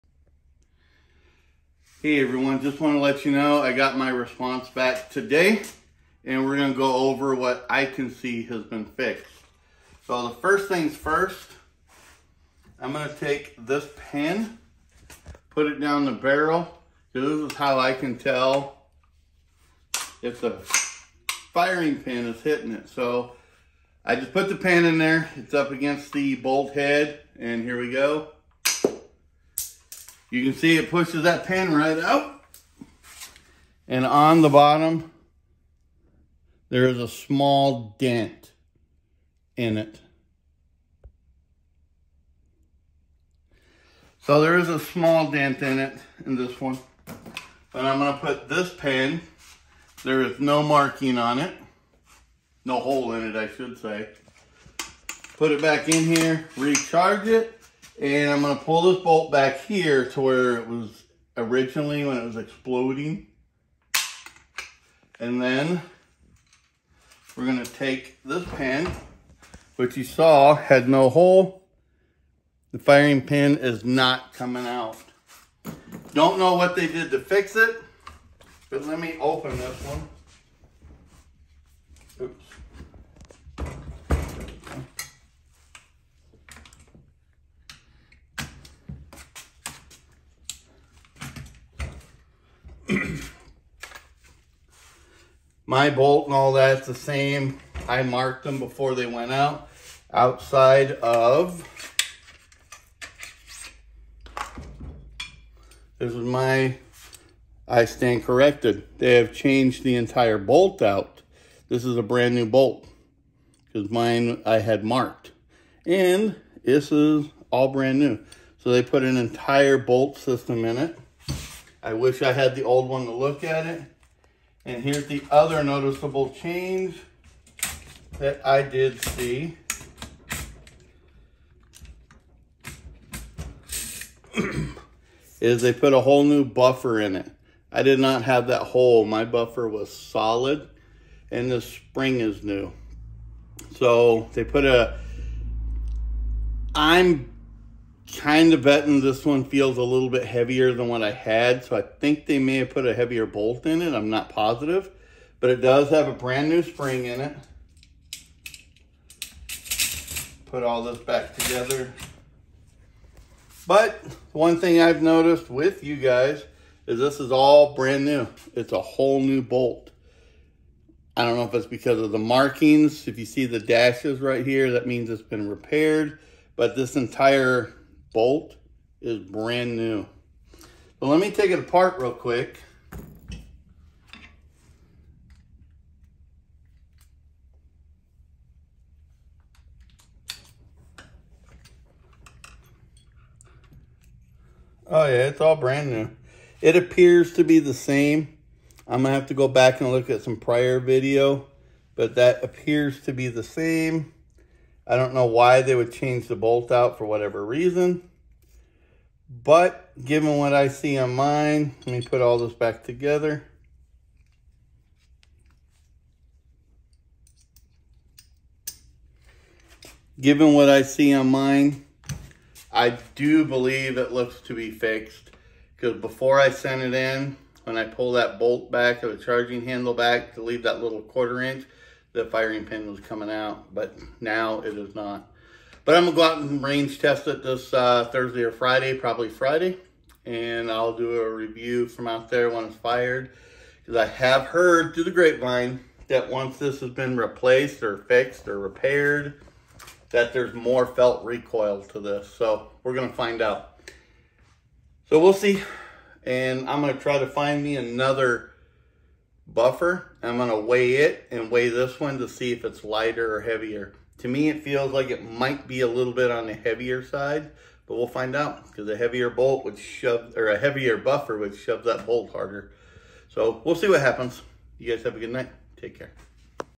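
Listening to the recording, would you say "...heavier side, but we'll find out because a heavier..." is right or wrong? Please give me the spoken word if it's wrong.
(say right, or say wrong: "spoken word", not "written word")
right.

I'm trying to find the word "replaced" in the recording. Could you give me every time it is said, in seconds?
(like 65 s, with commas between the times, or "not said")
247 s.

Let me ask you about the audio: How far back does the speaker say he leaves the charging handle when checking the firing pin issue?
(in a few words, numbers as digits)
quarter inch.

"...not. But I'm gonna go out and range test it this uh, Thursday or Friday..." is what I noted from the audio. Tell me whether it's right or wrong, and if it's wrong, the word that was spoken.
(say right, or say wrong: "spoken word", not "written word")
right.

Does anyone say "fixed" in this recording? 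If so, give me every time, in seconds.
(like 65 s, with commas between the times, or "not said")
8 s, 224 s, 247 s.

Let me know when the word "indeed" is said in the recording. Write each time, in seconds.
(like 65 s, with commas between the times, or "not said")
not said.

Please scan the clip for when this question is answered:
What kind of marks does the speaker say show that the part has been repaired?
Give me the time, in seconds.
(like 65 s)
173 s.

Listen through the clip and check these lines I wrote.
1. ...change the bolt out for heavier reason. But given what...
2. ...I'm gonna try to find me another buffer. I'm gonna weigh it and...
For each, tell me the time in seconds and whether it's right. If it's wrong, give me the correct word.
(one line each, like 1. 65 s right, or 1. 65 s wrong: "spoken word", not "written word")
1. 205 s wrong: "whatever", not "heavier"
2. 256 s right.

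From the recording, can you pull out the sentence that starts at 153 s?
I'm not positive, but it does have a brand new spring in it.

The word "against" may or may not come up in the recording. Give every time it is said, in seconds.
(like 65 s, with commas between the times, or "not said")
25 s.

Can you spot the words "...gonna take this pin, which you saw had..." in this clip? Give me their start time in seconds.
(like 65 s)
67 s.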